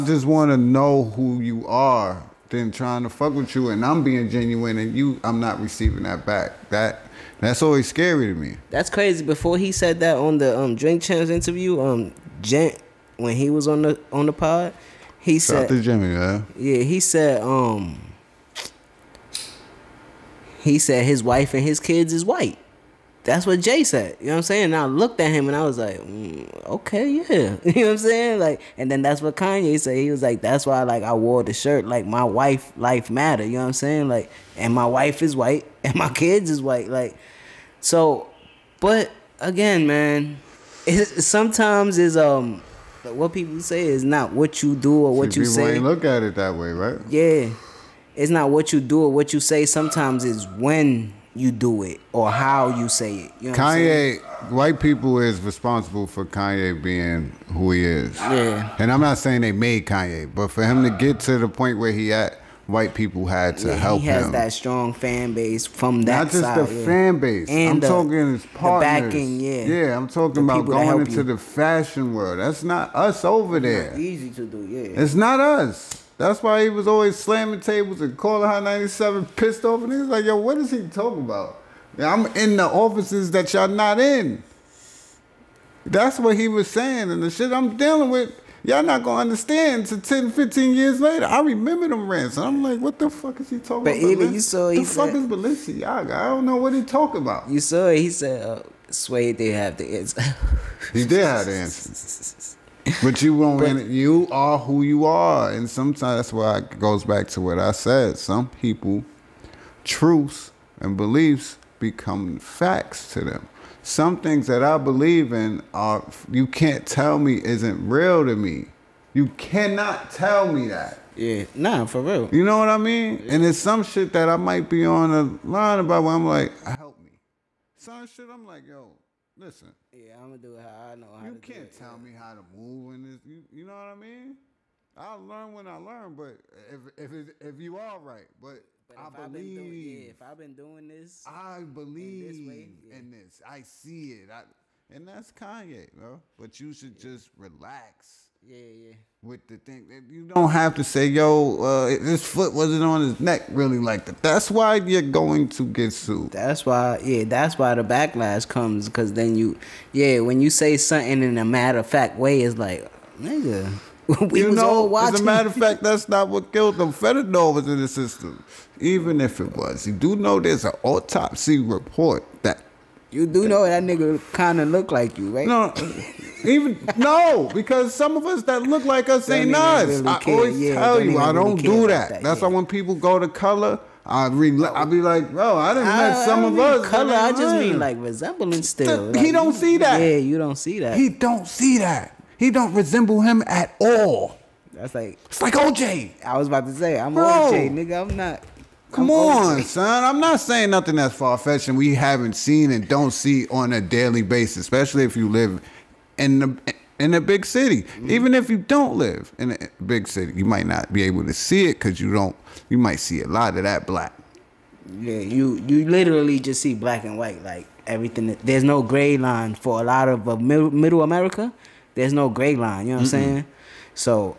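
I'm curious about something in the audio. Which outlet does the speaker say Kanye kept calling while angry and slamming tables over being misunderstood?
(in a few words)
Hot 97.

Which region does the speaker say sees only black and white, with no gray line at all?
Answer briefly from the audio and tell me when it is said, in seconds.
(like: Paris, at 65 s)
Middle America, at 220 s.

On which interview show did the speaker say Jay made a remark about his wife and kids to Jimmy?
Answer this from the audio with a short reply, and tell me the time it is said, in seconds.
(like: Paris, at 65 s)
Drink Champs, at 10 s.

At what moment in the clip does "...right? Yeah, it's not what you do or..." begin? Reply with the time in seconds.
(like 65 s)
46 s.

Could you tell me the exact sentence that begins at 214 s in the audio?
Yeah, you you literally just see black and white.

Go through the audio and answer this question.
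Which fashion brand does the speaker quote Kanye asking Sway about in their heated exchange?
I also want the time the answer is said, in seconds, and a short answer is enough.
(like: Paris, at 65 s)
Balenciaga, at 95 s.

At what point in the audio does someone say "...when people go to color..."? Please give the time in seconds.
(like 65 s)
182 s.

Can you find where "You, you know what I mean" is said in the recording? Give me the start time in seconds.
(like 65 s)
133 s.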